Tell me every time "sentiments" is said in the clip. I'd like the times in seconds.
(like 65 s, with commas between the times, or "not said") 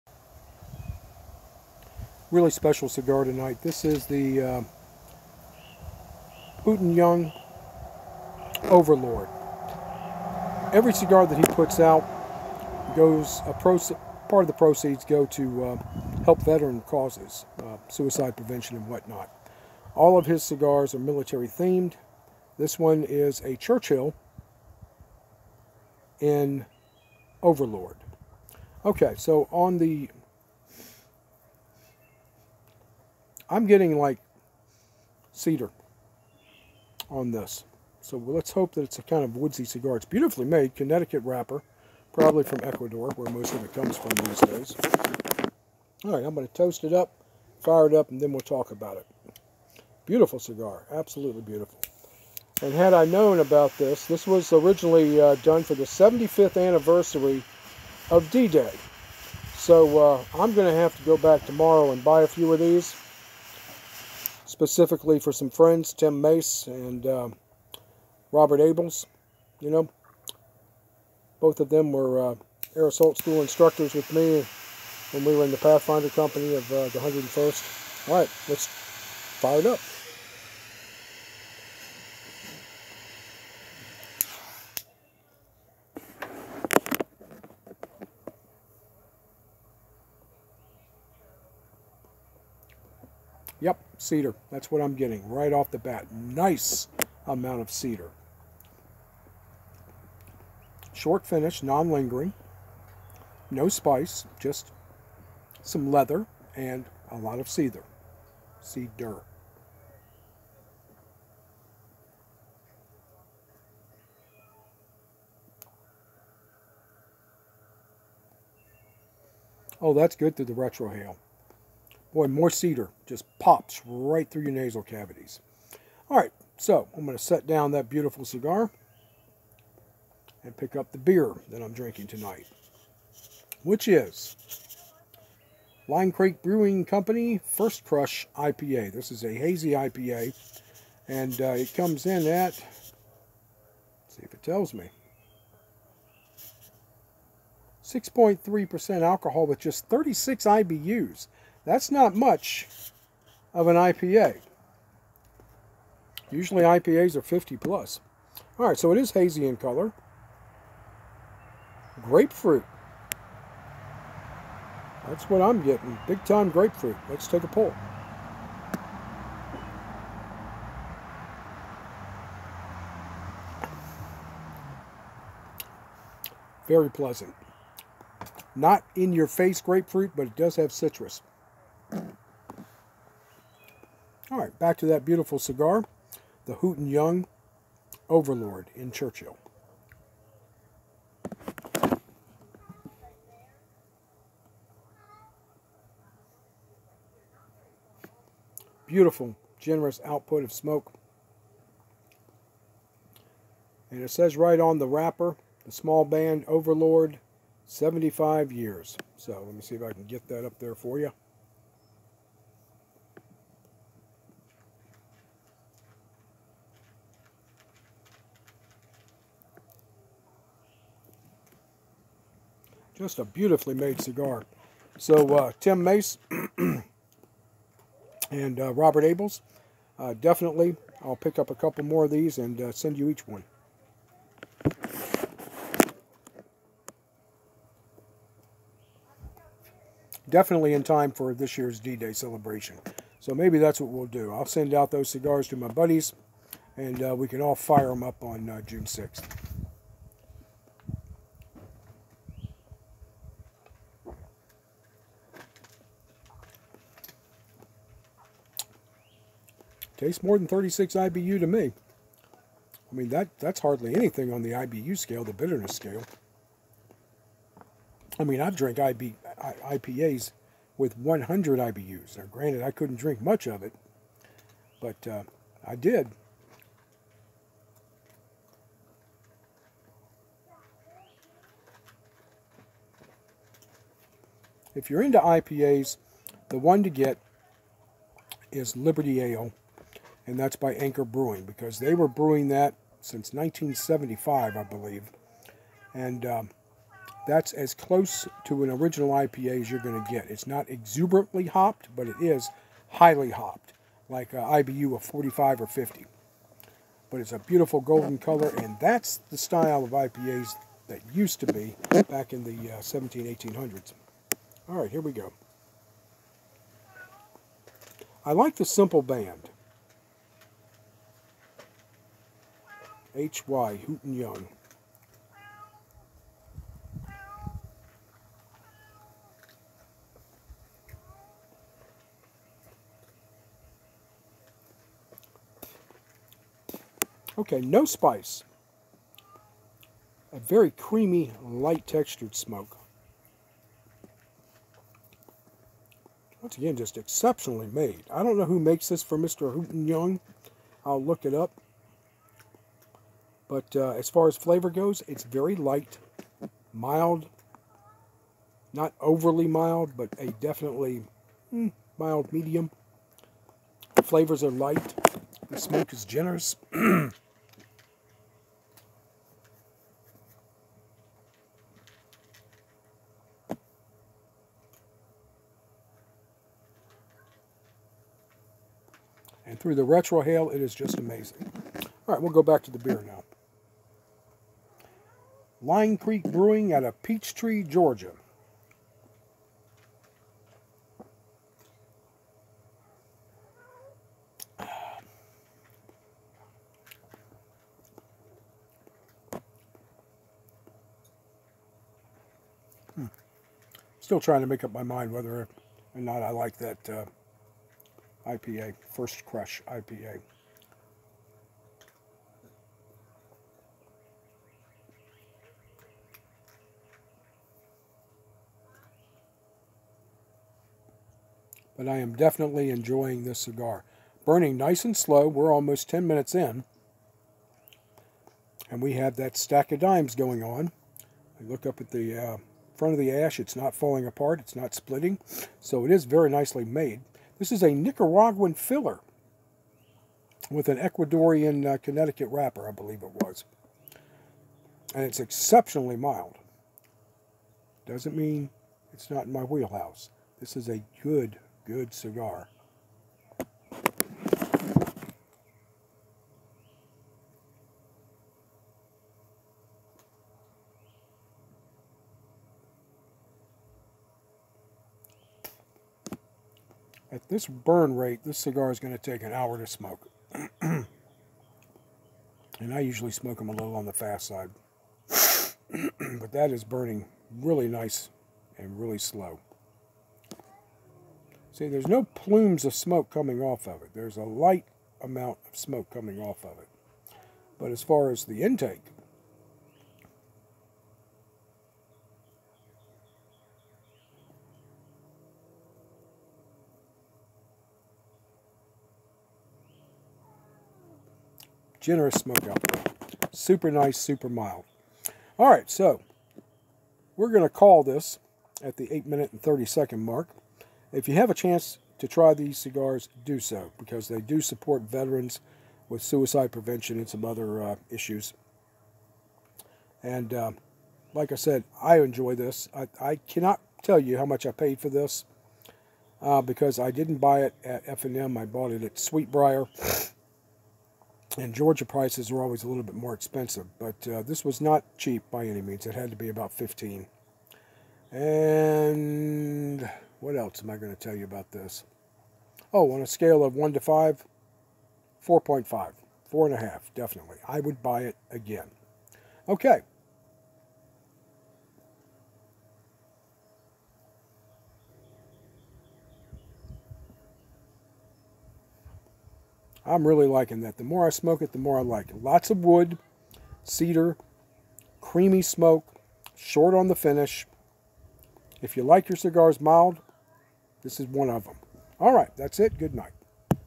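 not said.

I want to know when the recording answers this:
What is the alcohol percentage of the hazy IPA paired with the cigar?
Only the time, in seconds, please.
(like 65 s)
147 s.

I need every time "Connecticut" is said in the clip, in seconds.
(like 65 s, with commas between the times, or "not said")
40 s, 441 s.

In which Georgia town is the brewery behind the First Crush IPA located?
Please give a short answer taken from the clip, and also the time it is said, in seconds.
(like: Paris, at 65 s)
Peachtree, at 387 s.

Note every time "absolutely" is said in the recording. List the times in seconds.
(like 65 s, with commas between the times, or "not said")
50 s.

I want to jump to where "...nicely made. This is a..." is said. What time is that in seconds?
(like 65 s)
436 s.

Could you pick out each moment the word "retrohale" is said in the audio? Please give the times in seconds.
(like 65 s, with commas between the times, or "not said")
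120 s, 379 s.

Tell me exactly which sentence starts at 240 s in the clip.
Definitely in time for this year's D-Day celebration.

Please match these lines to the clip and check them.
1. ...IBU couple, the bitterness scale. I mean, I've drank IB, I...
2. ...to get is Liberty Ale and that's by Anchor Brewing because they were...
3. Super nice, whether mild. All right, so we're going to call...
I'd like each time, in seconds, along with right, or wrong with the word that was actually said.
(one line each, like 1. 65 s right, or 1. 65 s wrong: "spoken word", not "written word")
1. 264 s wrong: "scale", not "couple"
2. 286 s right
3. 503 s wrong: "super", not "whether".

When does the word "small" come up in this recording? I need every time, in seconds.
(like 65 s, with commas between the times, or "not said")
205 s.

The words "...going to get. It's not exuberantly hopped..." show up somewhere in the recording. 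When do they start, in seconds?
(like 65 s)
299 s.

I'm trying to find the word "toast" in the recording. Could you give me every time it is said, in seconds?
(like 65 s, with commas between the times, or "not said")
46 s.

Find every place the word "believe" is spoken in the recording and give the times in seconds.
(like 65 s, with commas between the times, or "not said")
294 s, 442 s.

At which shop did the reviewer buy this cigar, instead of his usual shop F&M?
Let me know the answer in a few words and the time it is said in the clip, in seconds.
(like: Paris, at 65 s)
Sweetbriar, at 528 s.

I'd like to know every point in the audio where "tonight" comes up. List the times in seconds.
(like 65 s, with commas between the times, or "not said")
3 s, 132 s.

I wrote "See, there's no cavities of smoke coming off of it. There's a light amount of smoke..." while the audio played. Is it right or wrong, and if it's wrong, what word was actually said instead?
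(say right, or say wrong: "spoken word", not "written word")
wrong: "plumes", not "cavities".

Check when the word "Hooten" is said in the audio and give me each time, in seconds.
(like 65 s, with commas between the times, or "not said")
6 s, 186 s, 323 s, 349 s.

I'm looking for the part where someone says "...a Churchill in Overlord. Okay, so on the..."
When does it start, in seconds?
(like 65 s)
23 s.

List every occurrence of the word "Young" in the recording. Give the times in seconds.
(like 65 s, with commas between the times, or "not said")
6 s, 186 s, 324 s, 349 s.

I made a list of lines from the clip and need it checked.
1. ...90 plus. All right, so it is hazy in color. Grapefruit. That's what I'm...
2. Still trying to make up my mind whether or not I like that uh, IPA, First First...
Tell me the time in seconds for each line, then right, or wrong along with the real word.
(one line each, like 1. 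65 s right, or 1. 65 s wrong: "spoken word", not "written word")
1. 157 s wrong: "50", not "90"
2. 403 s wrong: "Crush", not "First".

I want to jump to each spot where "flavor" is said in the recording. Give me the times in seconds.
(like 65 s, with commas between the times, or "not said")
354 s, 364 s.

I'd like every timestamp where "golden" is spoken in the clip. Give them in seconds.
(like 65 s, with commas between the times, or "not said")
307 s.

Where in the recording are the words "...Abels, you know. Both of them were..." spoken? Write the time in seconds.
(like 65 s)
68 s.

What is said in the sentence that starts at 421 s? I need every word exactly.
but I am definitely enjoying this cigar.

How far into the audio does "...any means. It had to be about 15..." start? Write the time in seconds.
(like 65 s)
535 s.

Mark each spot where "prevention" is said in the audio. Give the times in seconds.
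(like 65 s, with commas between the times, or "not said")
18 s, 516 s.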